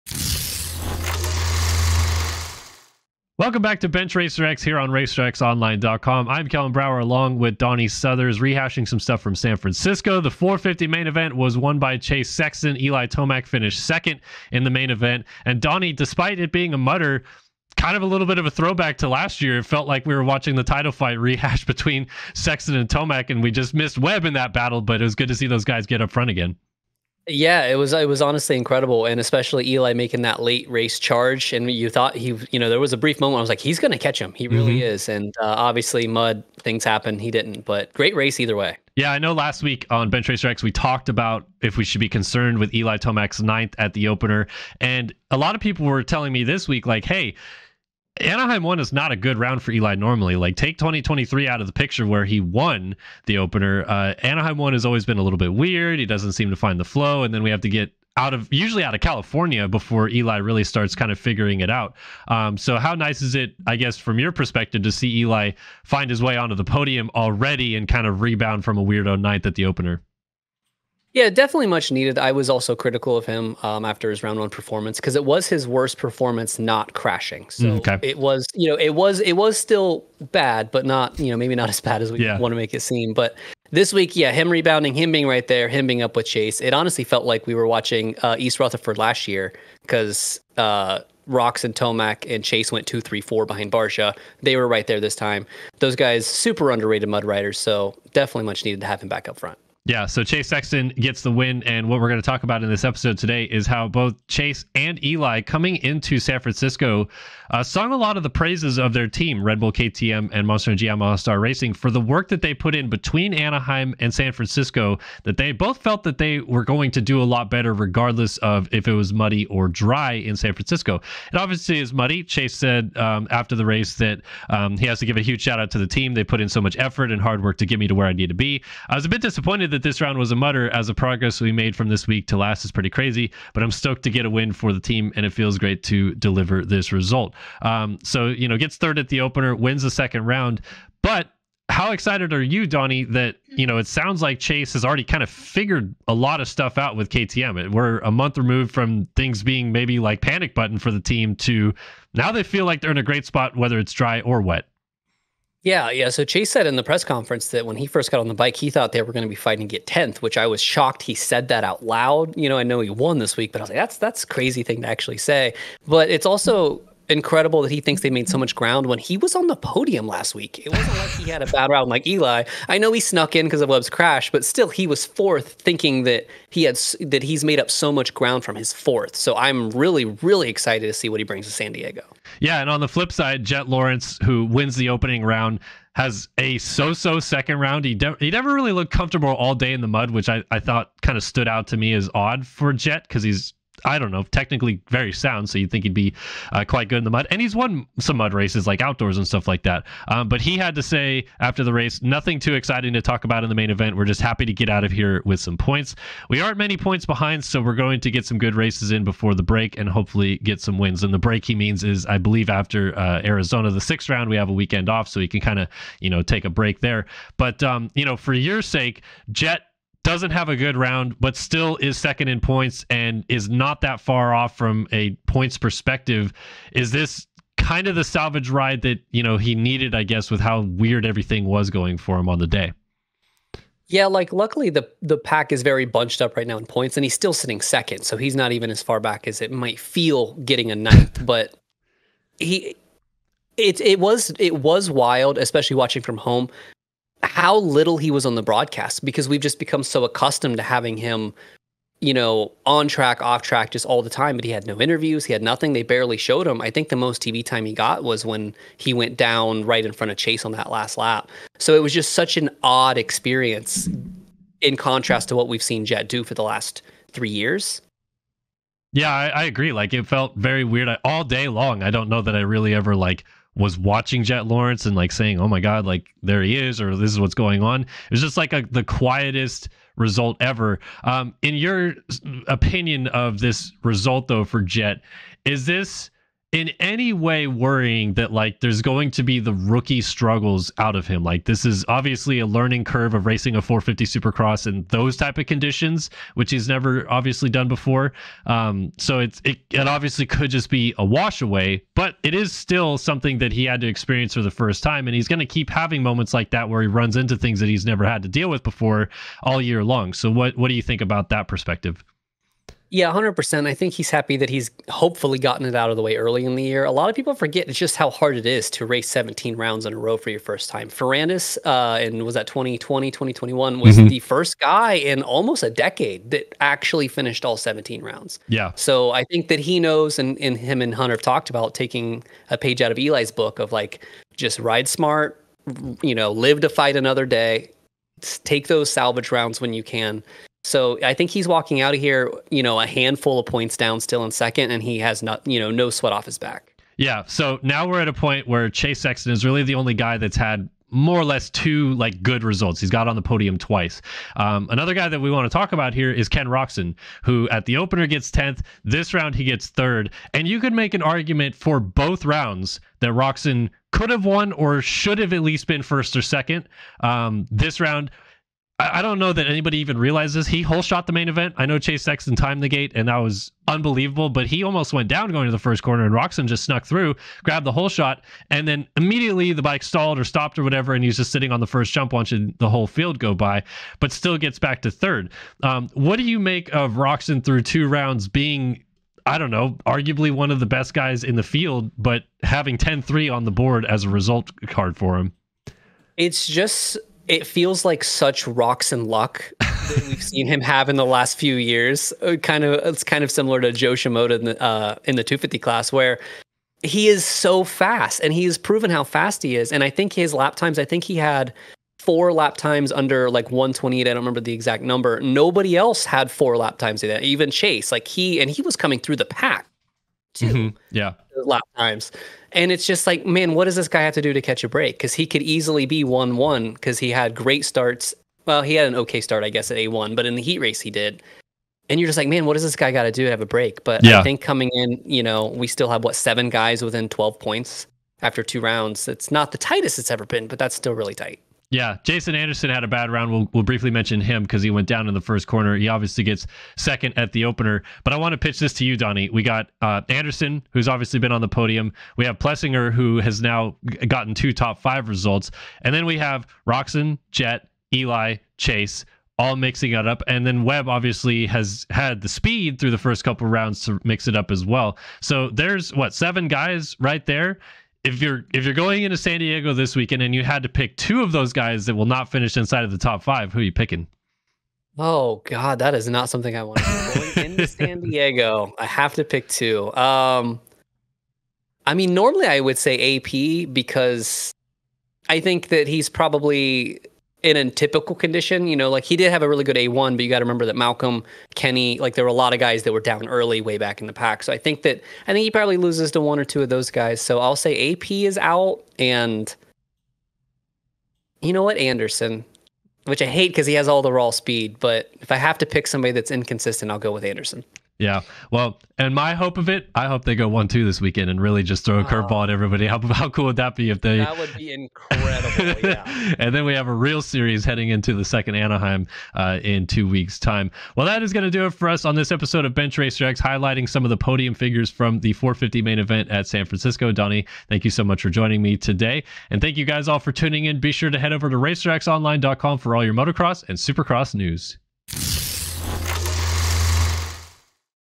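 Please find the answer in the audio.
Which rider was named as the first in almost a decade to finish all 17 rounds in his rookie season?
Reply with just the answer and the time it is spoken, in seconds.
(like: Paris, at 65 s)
Ferrandis, at 320 s.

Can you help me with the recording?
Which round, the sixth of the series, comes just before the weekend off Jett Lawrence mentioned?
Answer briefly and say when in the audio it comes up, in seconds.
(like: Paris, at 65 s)
Arizona, at 213 s.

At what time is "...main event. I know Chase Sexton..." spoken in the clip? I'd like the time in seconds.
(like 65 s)
371 s.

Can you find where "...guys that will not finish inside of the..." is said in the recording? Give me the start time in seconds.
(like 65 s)
471 s.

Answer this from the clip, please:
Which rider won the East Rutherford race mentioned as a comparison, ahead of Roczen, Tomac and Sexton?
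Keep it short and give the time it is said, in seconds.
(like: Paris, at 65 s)
Barcia, at 93 s.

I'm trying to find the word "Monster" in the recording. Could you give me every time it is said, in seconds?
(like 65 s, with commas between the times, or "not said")
110 s.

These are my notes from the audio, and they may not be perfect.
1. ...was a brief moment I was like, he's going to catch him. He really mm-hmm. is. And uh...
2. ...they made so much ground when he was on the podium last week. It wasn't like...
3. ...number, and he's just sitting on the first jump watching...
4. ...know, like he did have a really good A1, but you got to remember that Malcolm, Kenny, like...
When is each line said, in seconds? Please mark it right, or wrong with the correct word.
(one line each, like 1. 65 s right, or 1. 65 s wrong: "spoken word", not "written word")
1. 32 s right
2. 168 s right
3. 380 s wrong: "whatever", not "number"
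4. 488 s right.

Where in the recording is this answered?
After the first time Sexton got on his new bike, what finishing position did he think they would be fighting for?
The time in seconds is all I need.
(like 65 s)
159 s.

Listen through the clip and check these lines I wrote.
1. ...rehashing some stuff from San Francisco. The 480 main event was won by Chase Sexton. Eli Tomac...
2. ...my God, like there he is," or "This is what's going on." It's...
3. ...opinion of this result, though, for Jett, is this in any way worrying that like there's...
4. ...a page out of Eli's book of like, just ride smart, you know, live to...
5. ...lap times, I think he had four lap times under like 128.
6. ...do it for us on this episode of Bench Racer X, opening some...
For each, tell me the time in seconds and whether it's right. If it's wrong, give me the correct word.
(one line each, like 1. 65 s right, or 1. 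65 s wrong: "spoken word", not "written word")
1. 8 s wrong: "450", not "480"
2. 275 s right
3. 282 s right
4. 332 s right
5. 410 s right
6. 521 s wrong: "highlighting", not "opening".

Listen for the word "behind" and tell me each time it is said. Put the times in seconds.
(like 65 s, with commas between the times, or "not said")
93 s, 207 s.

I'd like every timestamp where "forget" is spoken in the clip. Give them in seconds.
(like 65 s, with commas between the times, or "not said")
317 s.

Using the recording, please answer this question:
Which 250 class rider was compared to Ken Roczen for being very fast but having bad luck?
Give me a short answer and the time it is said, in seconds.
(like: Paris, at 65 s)
Jo Shimoda, at 403 s.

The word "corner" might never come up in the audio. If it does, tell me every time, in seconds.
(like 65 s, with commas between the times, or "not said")
375 s, 445 s.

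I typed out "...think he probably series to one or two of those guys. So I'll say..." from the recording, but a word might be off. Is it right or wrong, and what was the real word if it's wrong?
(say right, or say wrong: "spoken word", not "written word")
wrong: "loses", not "series".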